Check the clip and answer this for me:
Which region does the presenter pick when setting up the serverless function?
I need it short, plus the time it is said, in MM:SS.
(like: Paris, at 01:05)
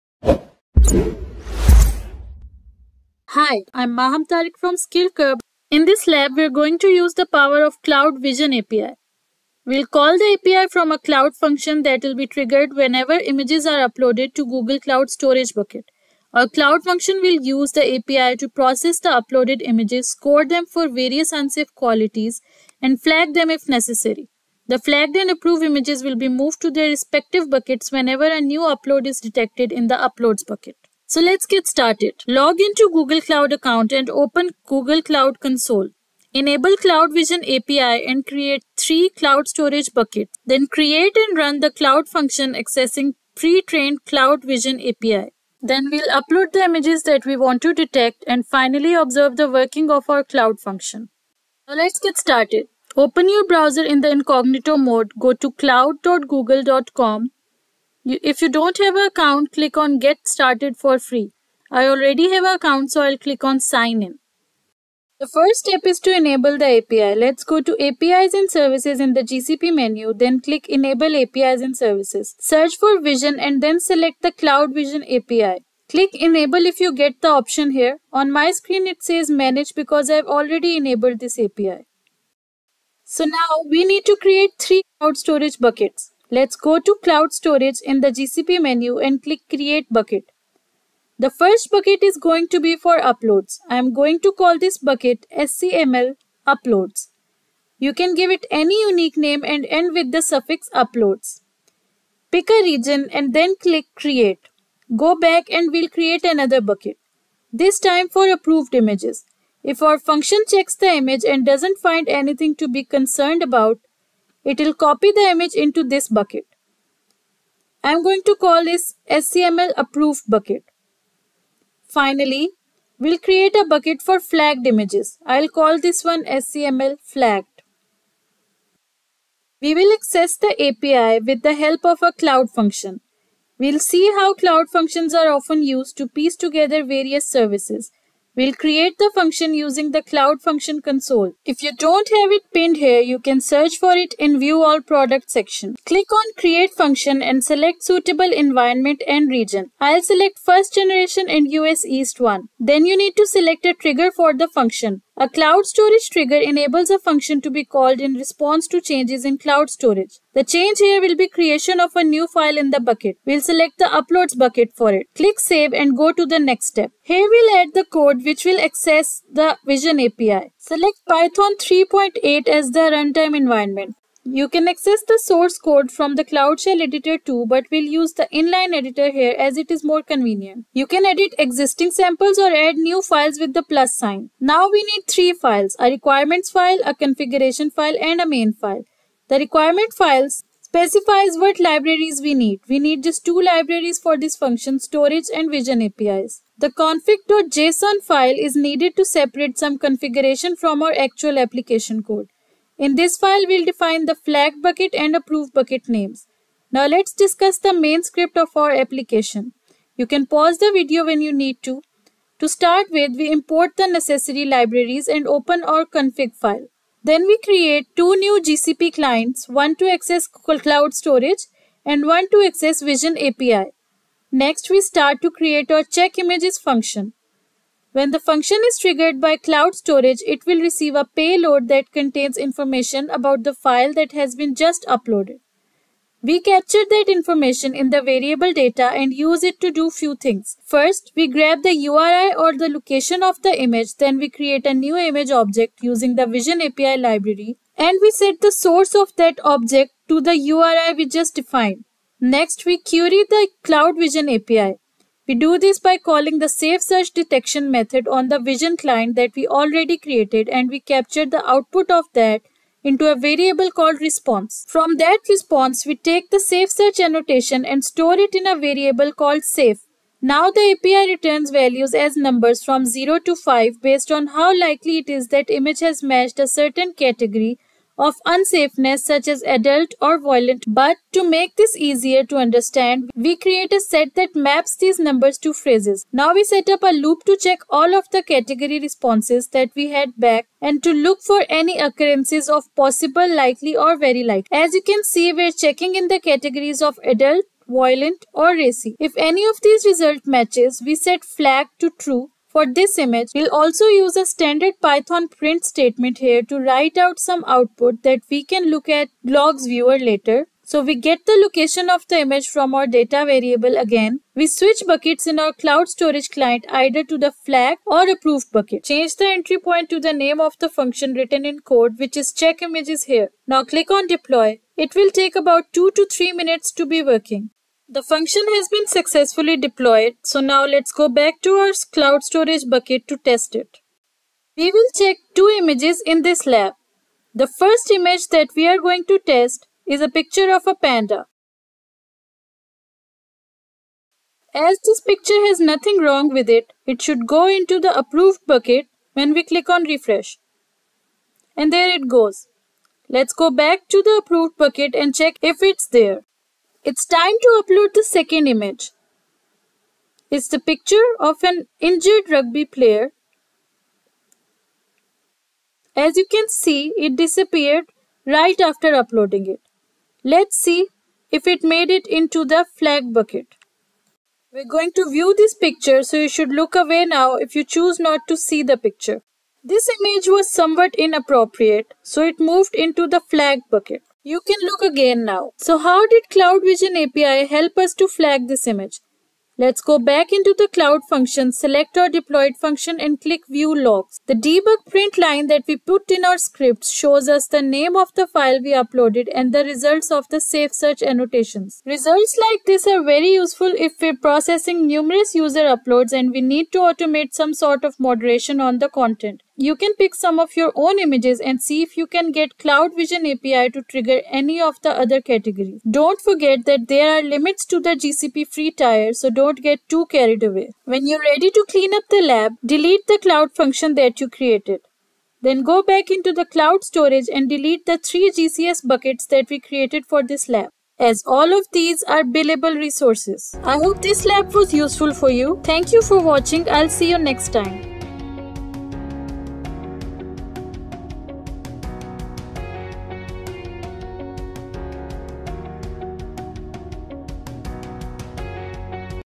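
US East 1, at 02:31.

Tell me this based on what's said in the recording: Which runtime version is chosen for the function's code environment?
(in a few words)
Python 3.8.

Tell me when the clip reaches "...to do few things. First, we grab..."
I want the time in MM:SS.
03:59.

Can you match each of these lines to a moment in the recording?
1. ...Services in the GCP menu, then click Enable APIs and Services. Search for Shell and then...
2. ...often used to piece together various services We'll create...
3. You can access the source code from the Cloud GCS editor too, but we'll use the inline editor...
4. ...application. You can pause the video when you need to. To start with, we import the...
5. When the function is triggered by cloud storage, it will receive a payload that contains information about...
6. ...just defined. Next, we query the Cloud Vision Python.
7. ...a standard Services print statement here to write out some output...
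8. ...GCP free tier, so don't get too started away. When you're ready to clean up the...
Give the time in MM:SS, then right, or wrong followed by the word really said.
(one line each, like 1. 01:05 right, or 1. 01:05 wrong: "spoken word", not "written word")
1. 01:08 wrong: "Vision", not "Shell"
2. 02:15 right
3. 02:54 wrong: "Shell", not "GCS"
4. 03:28 right
5. 03:47 right
6. 04:11 wrong: "API", not "Python"
7. 05:04 wrong: "Python", not "Services"
8. 06:58 wrong: "carried", not "started".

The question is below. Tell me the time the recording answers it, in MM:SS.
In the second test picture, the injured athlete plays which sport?
06:02.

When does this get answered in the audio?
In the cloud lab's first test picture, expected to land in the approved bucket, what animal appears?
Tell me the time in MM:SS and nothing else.
05:40.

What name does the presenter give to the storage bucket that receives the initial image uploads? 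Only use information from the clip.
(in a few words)
scml uploads.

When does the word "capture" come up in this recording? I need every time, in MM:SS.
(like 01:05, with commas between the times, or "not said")
03:56, 04:20.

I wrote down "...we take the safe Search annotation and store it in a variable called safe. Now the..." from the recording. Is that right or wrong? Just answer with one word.
right.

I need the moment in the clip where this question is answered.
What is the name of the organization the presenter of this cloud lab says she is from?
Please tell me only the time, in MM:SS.
00:04.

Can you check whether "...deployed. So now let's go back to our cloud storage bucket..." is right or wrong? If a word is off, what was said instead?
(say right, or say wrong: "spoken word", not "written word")
right.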